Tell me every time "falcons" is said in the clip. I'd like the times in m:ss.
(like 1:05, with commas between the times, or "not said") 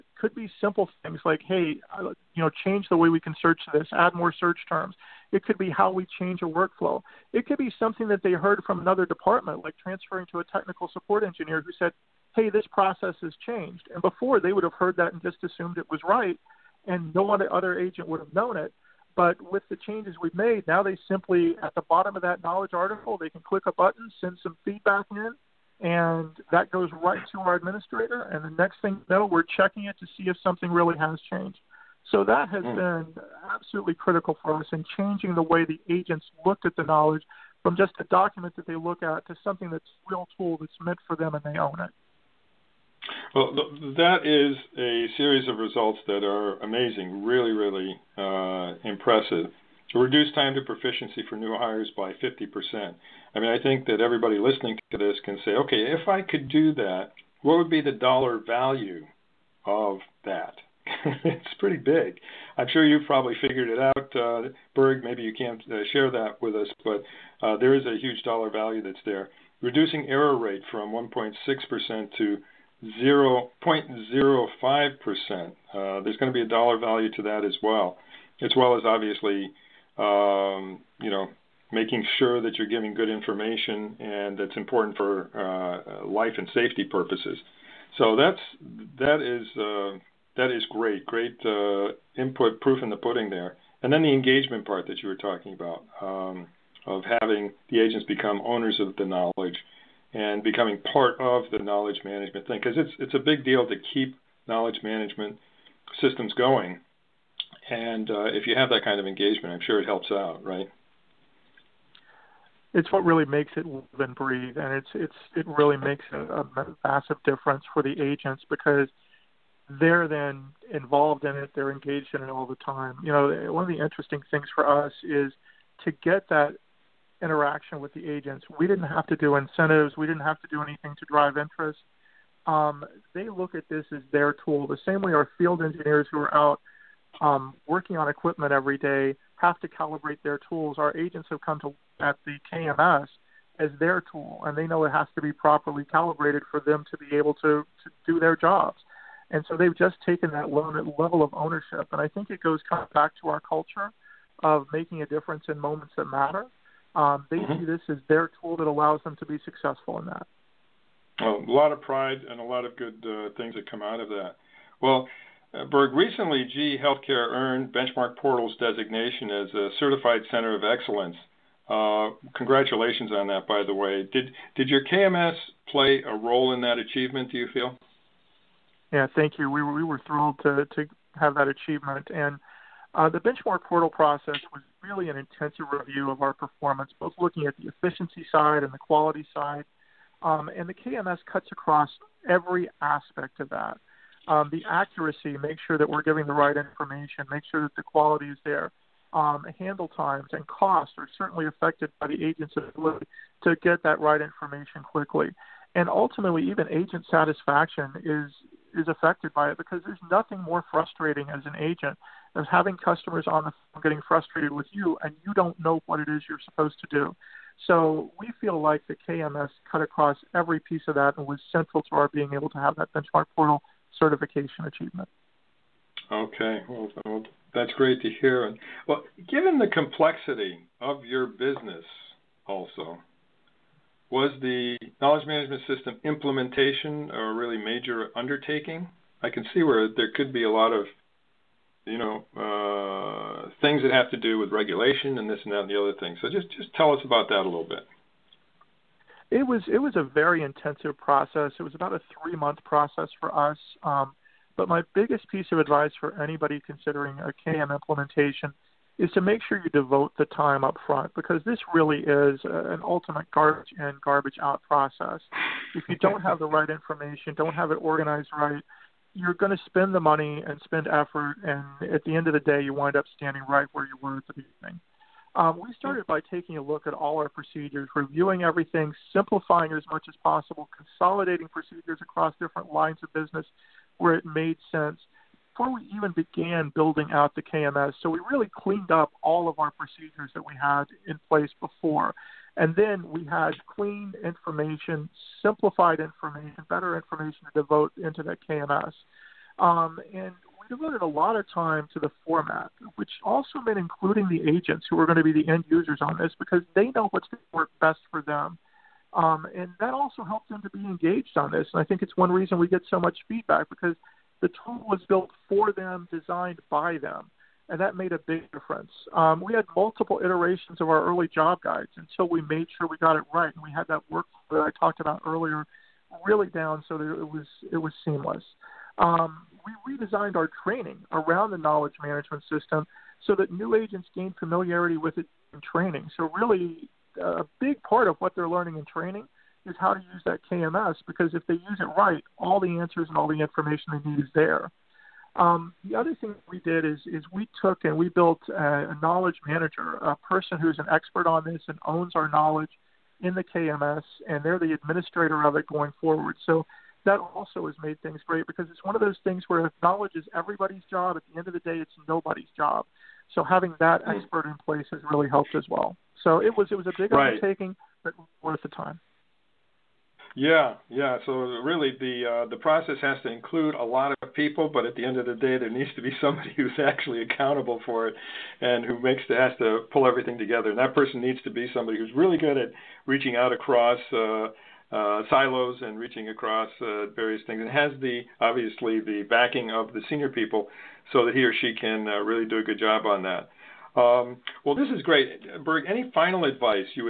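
not said.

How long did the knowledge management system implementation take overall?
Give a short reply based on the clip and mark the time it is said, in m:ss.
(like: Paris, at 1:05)
three month, at 4:12.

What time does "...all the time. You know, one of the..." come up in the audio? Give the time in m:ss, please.
2:02.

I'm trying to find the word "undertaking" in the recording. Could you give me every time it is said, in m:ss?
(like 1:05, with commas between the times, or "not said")
3:58, 6:07.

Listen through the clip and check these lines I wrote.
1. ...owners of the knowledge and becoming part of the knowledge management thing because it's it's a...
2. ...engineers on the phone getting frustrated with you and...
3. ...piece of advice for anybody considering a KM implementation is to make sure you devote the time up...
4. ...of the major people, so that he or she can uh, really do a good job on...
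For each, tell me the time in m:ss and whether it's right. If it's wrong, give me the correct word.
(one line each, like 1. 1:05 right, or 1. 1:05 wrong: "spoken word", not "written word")
1. 1:38 right
2. 3:32 wrong: "customers", not "engineers"
3. 4:15 right
4. 6:29 wrong: "senior", not "major".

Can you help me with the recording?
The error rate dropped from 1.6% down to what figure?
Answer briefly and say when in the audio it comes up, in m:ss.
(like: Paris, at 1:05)
0.05%, at 1:13.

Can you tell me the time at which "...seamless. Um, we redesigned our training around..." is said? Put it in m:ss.
5:28.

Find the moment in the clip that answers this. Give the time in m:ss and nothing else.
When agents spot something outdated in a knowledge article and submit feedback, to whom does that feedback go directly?
0:27.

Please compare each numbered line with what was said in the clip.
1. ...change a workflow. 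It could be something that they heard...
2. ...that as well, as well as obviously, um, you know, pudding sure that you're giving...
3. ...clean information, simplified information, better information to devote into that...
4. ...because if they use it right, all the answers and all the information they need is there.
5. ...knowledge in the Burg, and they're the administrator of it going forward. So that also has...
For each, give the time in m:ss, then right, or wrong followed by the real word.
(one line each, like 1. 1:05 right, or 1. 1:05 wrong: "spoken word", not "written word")
1. 0:06 right
2. 1:17 wrong: "making", not "pudding"
3. 4:53 right
4. 5:41 right
5. 5:52 wrong: "KMS", not "Burg".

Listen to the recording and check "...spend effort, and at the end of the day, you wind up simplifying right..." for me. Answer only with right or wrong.
wrong.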